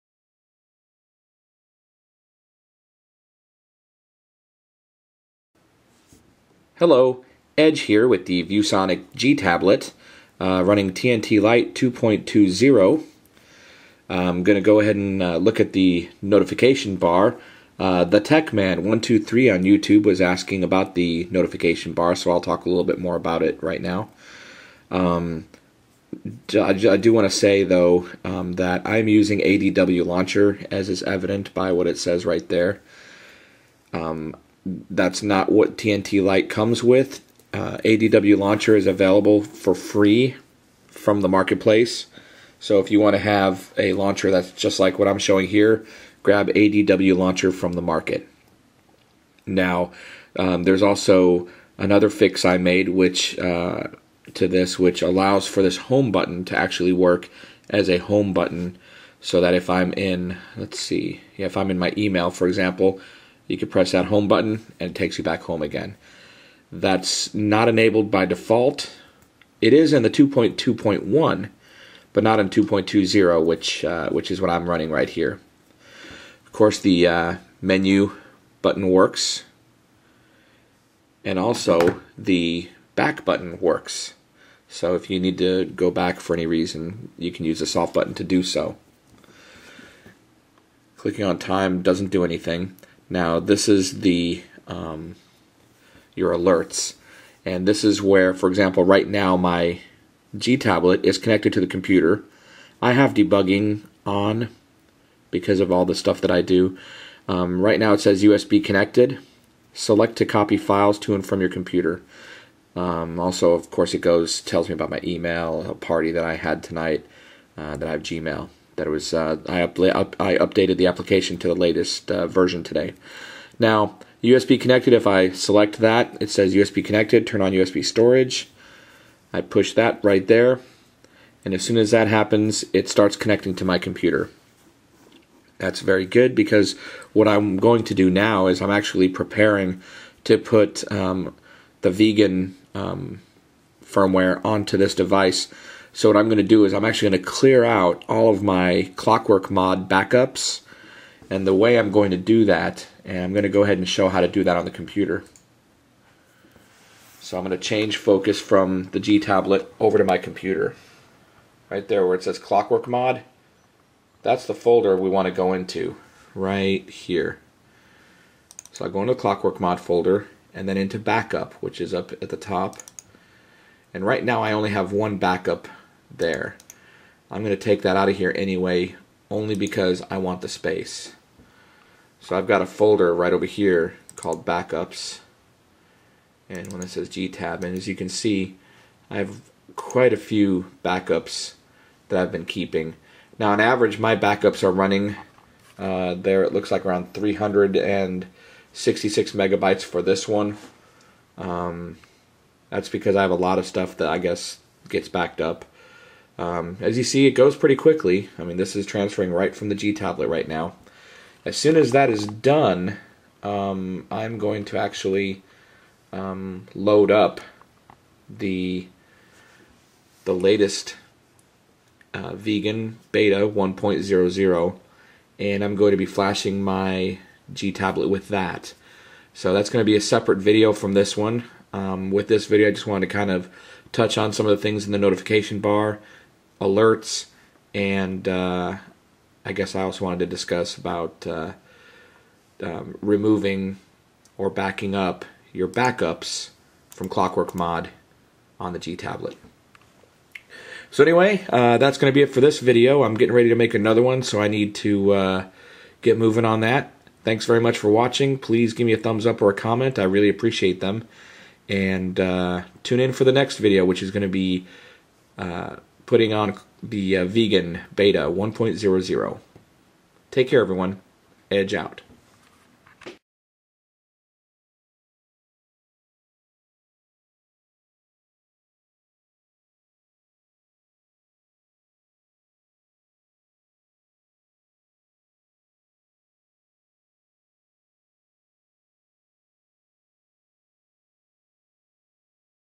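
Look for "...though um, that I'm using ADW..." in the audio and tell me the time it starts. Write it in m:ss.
0:27.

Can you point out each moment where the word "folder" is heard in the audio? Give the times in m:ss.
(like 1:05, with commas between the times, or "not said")
2:44, 2:49, 3:02.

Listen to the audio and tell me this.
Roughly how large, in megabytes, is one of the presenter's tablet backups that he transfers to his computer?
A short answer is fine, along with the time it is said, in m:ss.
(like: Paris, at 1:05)
366 megabytes, at 3:17.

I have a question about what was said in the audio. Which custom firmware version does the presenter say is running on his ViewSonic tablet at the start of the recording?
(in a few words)
TNT Lite 2.20.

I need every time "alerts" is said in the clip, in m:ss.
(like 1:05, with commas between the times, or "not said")
1:36, 3:56.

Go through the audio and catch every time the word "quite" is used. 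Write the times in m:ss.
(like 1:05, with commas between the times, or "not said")
3:09.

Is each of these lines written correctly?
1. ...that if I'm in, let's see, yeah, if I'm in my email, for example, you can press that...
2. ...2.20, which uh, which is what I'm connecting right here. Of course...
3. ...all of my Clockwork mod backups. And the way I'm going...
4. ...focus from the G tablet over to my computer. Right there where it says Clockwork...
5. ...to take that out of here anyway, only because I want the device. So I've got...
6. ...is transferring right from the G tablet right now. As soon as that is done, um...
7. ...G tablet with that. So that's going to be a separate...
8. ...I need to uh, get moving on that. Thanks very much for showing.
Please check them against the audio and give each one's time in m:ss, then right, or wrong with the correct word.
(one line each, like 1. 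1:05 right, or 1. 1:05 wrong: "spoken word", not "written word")
1. 0:59 right
2. 1:12 wrong: "running", not "connecting"
3. 2:28 right
4. 2:37 right
5. 2:57 wrong: "space", not "device"
6. 3:28 right
7. 3:47 right
8. 4:14 wrong: "watching", not "showing".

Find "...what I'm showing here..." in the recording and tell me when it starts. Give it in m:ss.
0:44.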